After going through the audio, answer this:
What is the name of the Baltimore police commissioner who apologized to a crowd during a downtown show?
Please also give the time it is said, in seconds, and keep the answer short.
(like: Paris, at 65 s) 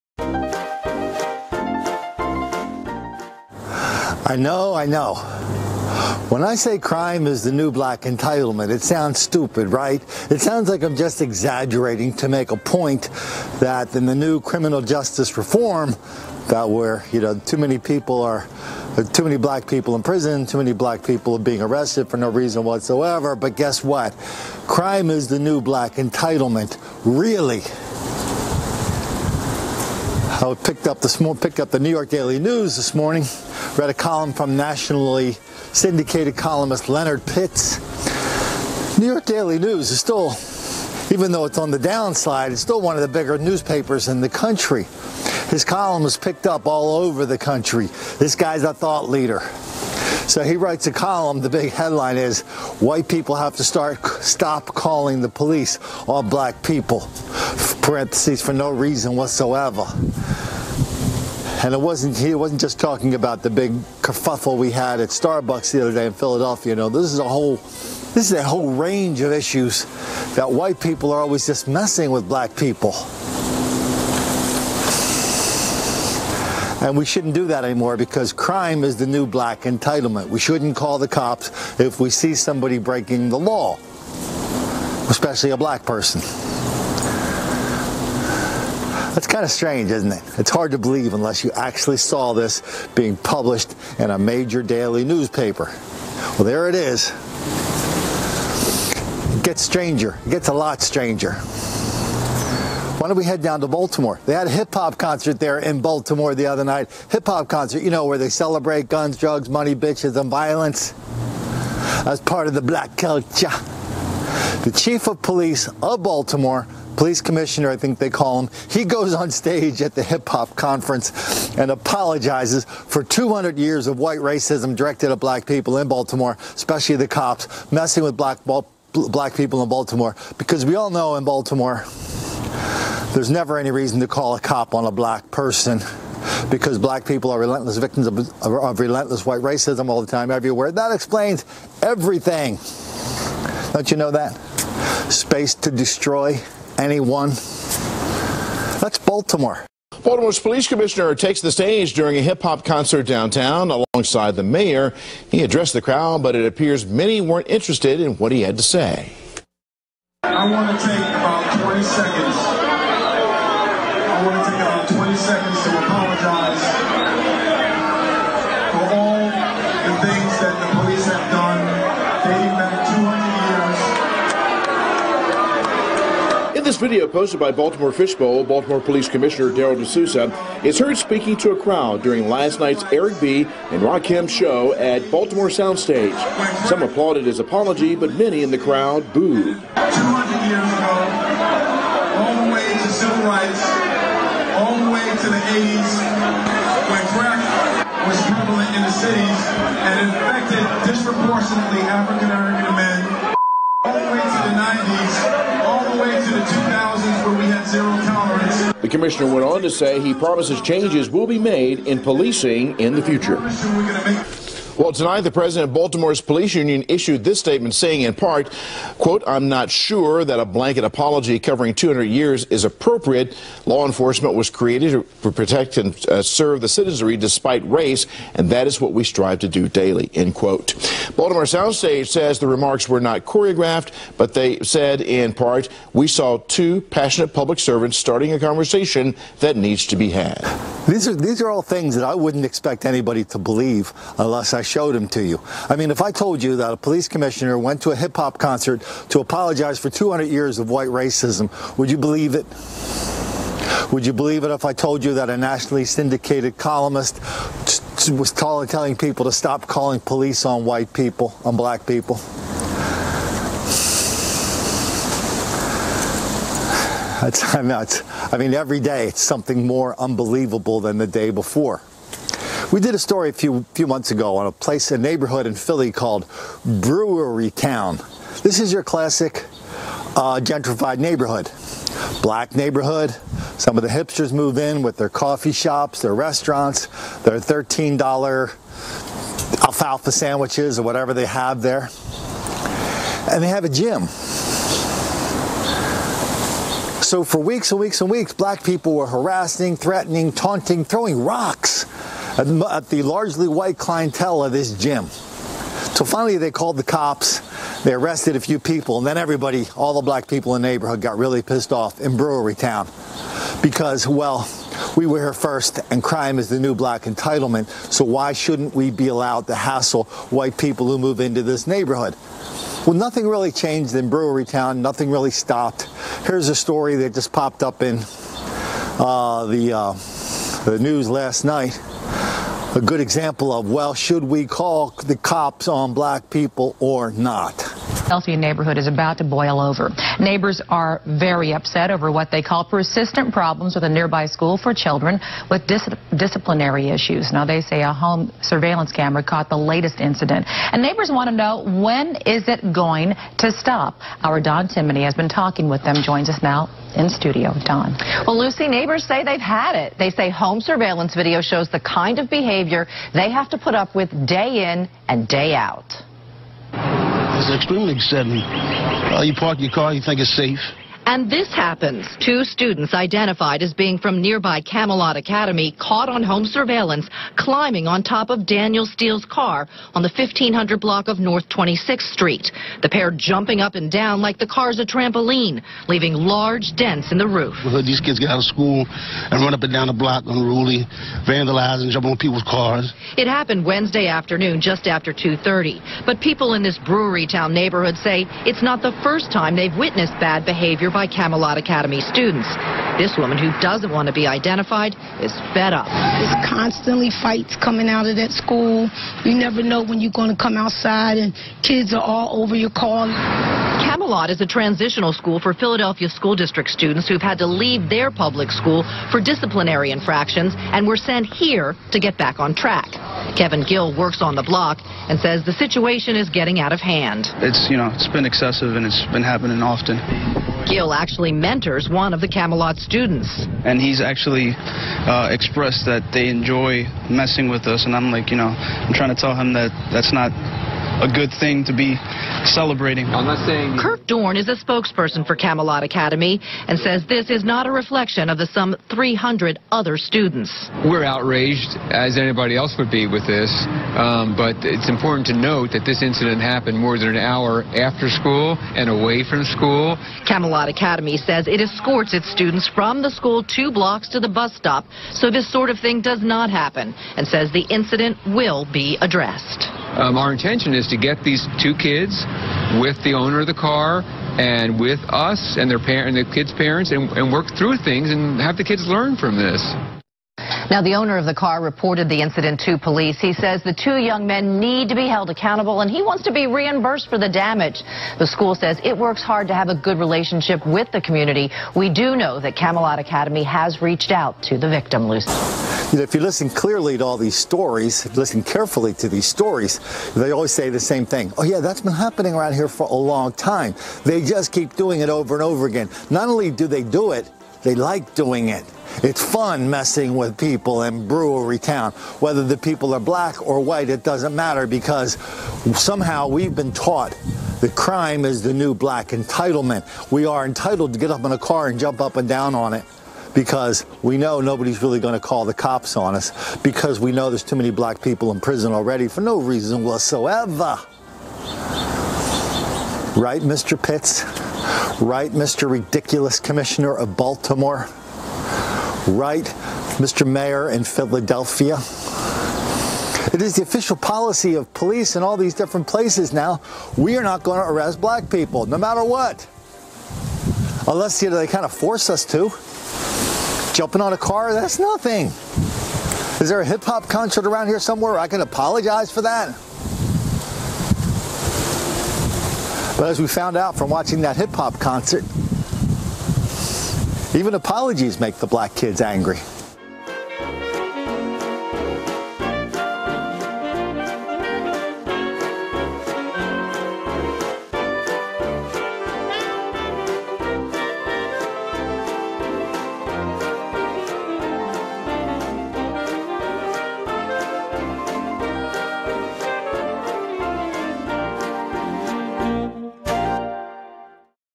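Darryl De Sousa, at 179 s.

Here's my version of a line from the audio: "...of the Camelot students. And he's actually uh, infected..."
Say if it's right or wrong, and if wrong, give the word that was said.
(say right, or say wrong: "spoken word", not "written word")
wrong: "expressed", not "infected".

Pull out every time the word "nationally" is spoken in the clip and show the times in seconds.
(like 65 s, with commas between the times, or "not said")
34 s, 255 s.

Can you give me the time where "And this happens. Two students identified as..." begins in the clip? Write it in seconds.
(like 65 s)
371 s.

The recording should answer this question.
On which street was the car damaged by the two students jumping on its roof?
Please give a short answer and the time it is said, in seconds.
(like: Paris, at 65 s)
North 26th Street, at 381 s.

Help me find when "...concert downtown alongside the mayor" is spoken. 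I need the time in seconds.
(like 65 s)
152 s.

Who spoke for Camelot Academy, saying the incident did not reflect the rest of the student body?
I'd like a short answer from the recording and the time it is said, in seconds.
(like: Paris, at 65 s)
Kirk Dorn, at 443 s.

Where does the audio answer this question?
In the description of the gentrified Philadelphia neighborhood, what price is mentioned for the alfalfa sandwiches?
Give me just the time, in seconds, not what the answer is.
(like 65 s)
287 s.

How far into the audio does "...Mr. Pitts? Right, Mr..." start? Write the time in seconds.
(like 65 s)
533 s.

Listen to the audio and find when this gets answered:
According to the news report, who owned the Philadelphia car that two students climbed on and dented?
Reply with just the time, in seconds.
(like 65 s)
378 s.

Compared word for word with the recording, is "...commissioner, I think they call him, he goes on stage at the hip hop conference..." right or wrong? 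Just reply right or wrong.
right.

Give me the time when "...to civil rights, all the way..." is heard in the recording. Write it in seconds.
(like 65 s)
192 s.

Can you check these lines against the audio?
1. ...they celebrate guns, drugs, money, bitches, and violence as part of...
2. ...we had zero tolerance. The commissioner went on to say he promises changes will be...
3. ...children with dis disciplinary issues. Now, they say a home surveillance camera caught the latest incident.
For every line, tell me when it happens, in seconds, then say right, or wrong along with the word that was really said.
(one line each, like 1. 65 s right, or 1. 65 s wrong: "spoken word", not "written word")
1. 108 s right
2. 207 s right
3. 344 s right.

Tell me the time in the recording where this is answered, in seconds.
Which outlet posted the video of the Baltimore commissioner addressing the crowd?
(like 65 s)
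177 s.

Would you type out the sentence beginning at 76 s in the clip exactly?
And we shouldn't do that anymore because crime is the new black entitlement.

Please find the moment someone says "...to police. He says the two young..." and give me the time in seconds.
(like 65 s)
482 s.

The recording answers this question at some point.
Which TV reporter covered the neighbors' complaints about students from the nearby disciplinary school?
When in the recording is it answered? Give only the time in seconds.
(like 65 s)
354 s.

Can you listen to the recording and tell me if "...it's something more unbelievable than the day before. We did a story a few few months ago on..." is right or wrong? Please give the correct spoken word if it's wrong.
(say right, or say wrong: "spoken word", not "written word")
right.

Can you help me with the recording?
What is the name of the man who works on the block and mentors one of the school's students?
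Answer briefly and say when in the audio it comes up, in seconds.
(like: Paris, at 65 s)
Kevin Gill, at 423 s.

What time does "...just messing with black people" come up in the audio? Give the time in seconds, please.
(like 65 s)
71 s.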